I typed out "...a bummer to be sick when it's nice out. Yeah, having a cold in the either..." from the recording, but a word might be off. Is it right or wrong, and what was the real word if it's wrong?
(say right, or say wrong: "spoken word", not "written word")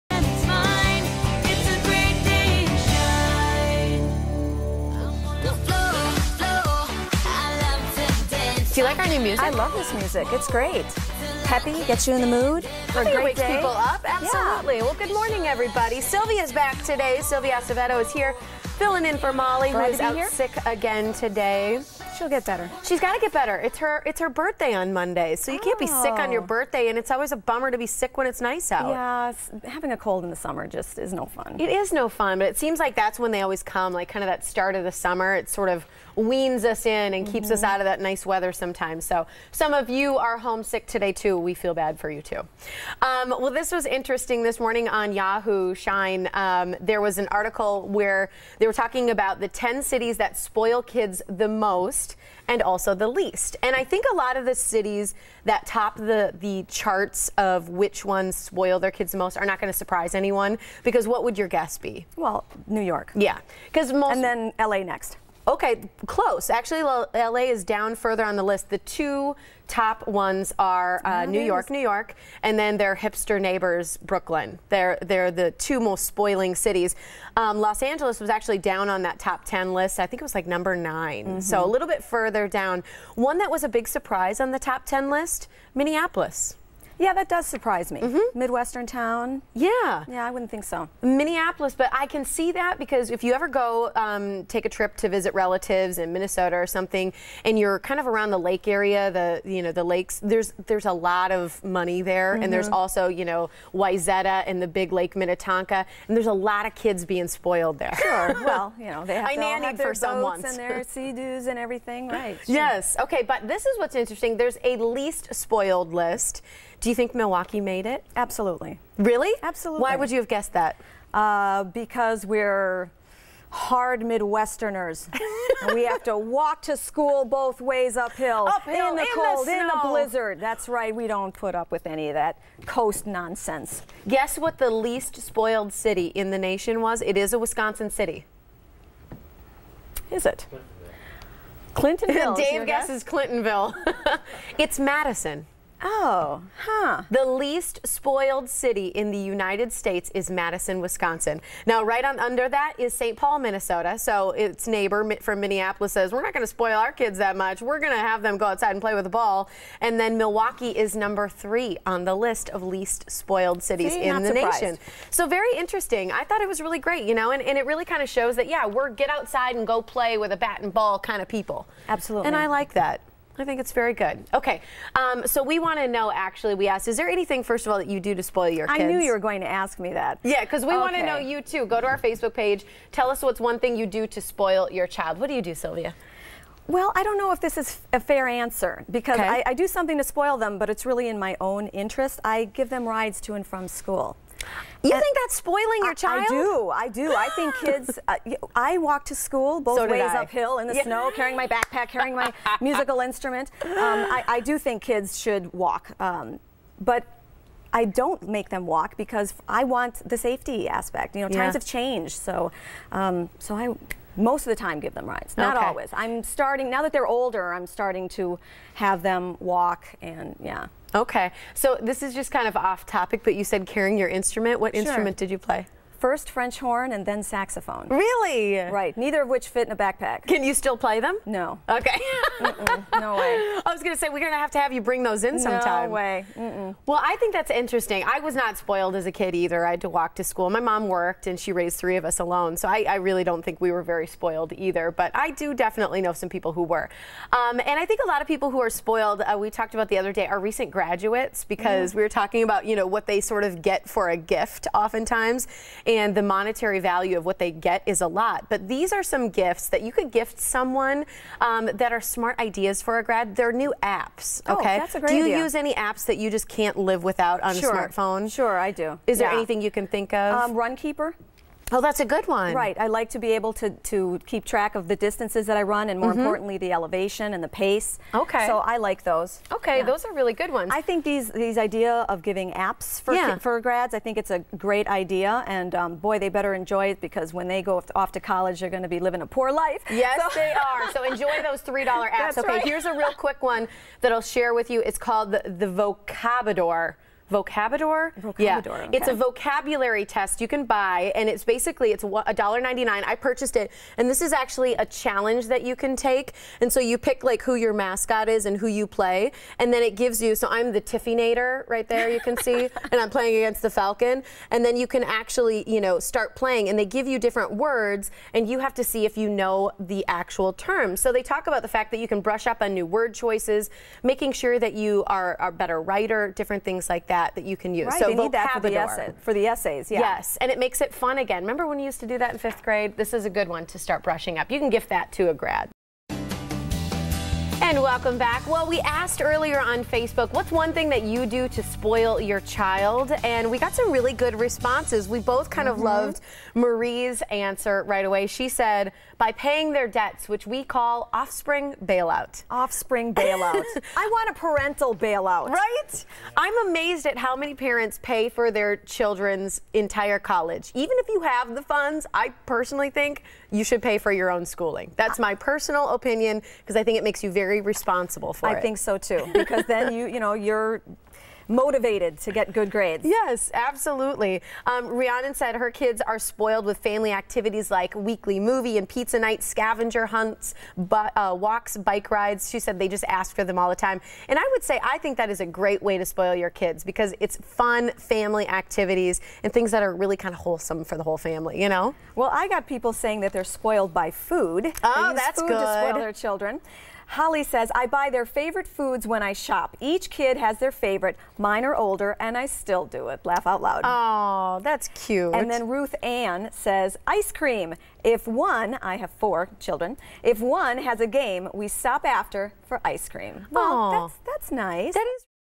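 wrong: "summer", not "either".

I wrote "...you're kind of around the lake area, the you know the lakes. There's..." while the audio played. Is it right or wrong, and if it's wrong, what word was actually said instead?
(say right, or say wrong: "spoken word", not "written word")
right.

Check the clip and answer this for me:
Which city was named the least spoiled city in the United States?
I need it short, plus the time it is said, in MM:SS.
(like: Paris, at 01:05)
Madison, Wisconsin, at 02:30.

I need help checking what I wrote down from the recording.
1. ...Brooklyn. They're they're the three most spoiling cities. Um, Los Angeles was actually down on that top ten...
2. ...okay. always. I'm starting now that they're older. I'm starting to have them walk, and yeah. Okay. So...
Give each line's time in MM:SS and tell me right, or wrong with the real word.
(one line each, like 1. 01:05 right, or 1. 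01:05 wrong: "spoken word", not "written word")
1. 01:13 wrong: "two", not "three"
2. 03:35 right.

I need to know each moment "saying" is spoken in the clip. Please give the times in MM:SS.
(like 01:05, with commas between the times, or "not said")
06:32.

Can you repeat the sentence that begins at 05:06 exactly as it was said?
And so you pick like who your mascot is and who you play, and then it gives you.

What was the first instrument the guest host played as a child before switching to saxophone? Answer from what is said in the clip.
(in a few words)
French horn.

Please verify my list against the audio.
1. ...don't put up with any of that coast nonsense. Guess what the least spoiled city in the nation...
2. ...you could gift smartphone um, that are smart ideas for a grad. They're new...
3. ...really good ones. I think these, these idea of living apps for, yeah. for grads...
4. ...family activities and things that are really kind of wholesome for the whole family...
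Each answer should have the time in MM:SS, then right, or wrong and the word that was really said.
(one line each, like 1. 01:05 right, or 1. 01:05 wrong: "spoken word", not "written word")
1. 02:11 right
2. 04:19 wrong: "someone", not "smartphone"
3. 04:40 wrong: "giving", not "living"
4. 06:27 right.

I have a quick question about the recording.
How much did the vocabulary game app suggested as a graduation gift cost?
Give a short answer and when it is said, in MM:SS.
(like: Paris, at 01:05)
$1.99, at 05:02.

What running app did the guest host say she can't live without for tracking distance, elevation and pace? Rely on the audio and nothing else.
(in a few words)
Runkeeper.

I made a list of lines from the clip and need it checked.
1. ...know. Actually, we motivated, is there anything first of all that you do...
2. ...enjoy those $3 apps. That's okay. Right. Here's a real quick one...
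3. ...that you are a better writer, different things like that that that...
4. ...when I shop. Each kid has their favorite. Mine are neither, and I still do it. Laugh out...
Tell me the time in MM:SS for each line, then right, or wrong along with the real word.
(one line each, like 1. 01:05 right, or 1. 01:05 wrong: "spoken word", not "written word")
1. 02:55 wrong: "asked", not "motivated"
2. 04:51 right
3. 05:24 right
4. 06:39 wrong: "older", not "neither".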